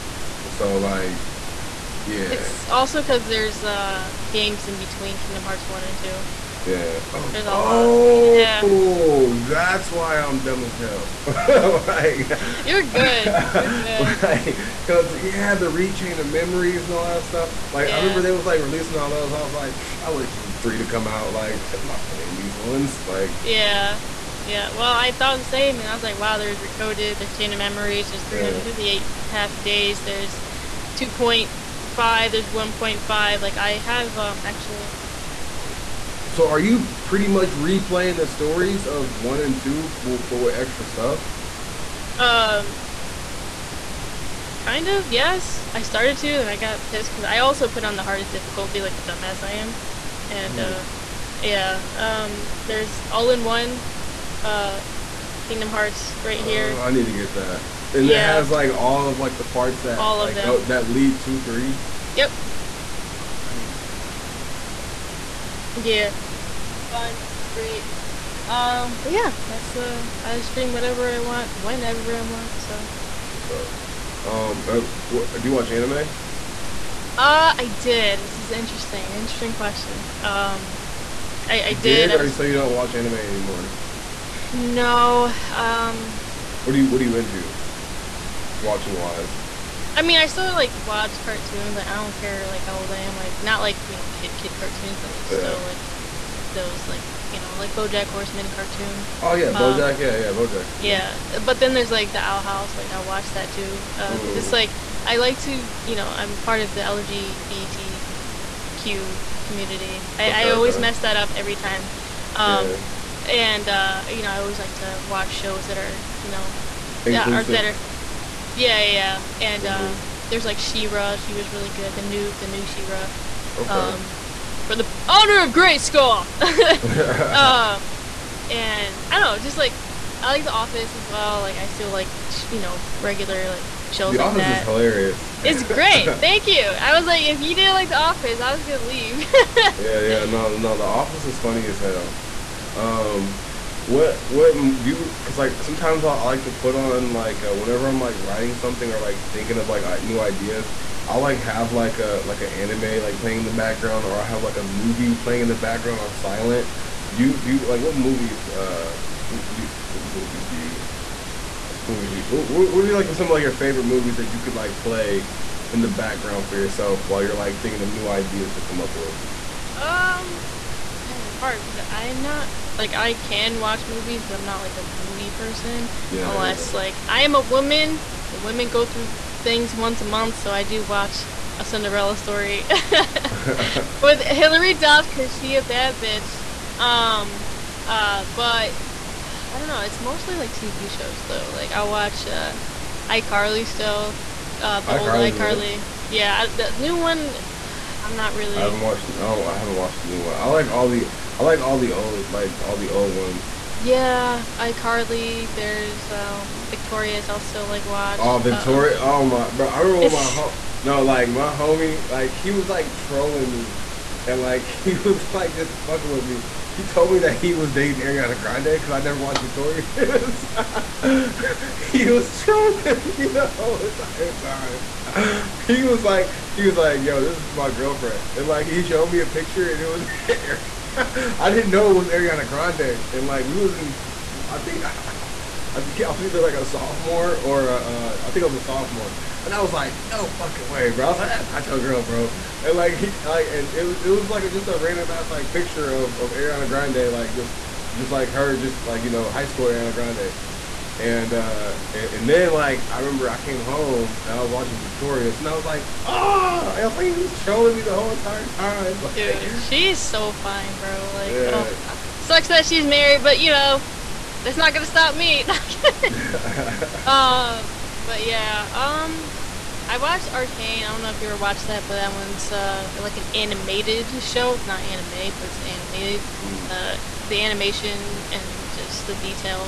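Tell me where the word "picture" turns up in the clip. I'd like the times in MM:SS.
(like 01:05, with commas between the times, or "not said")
03:49, 04:05.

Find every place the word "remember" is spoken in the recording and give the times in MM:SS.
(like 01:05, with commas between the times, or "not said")
00:17, 03:29, 04:12.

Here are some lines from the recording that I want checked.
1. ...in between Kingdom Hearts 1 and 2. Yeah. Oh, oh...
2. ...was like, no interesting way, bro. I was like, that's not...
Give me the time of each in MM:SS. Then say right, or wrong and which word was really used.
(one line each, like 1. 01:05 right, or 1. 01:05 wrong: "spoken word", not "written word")
1. 00:04 right
2. 03:59 wrong: "fucking", not "interesting".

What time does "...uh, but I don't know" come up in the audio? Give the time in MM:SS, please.
03:07.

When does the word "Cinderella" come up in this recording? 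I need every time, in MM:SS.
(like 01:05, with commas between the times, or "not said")
03:01.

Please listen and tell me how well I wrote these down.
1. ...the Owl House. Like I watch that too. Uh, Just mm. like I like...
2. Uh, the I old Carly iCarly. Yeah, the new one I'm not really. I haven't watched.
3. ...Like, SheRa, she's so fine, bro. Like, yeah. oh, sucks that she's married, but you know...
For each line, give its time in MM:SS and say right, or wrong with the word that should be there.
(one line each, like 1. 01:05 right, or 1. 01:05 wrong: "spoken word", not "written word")
1. 01:42 right
2. 03:14 right
3. 04:18 wrong: "Dude", not "SheRa".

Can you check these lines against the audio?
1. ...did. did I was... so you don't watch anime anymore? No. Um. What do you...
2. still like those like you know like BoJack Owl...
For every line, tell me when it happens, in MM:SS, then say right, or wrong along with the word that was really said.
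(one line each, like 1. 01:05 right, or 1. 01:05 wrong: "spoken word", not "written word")
1. 01:21 right
2. 01:35 wrong: "Horseman", not "Owl".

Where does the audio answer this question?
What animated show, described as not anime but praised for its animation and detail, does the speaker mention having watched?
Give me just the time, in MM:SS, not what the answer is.
04:30.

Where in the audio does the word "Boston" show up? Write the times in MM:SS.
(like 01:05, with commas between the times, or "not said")
not said.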